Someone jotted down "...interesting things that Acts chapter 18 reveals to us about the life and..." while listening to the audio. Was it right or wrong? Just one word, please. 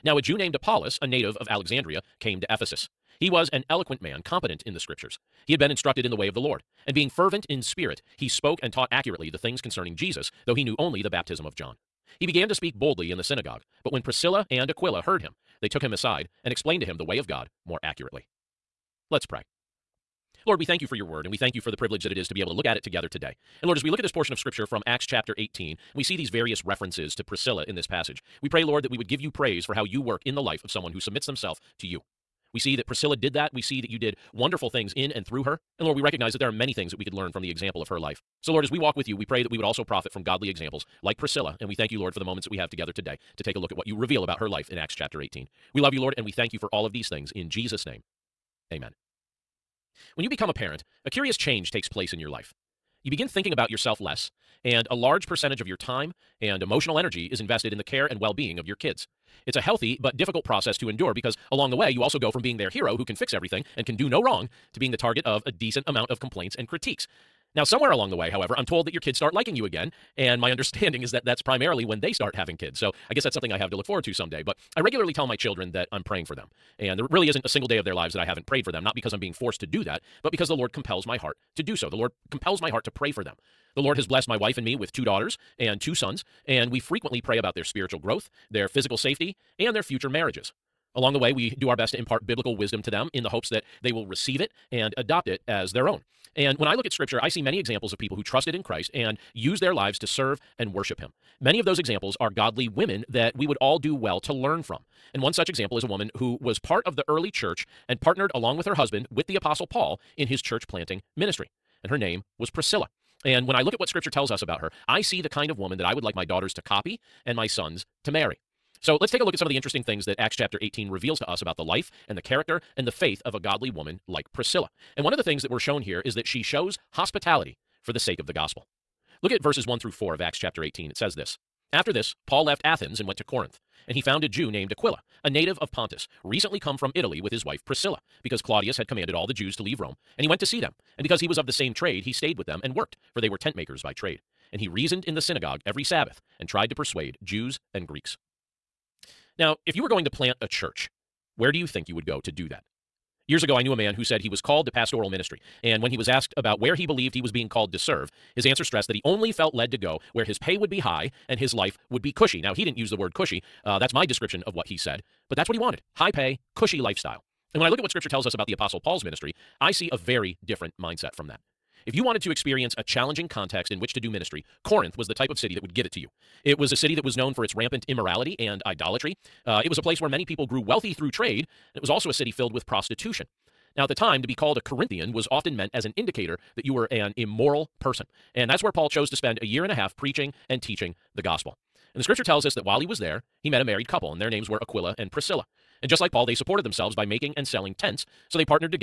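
right.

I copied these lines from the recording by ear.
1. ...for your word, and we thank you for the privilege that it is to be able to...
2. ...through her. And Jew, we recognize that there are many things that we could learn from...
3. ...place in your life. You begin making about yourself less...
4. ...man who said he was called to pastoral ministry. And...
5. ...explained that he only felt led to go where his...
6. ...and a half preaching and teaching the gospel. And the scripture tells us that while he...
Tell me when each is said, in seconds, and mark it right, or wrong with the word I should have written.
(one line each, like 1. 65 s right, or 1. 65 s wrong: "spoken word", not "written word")
1. 20 s right
2. 35 s wrong: "Lord", not "Jew"
3. 51 s wrong: "thinking", not "making"
4. 153 s right
5. 158 s wrong: "stressed", not "explained"
6. 189 s right.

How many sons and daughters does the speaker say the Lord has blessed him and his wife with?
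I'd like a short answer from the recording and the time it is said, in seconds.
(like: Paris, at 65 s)
two daughters and two sons, at 84 s.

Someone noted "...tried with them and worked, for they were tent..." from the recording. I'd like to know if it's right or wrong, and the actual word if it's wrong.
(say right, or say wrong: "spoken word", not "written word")
wrong: "stayed", not "tried".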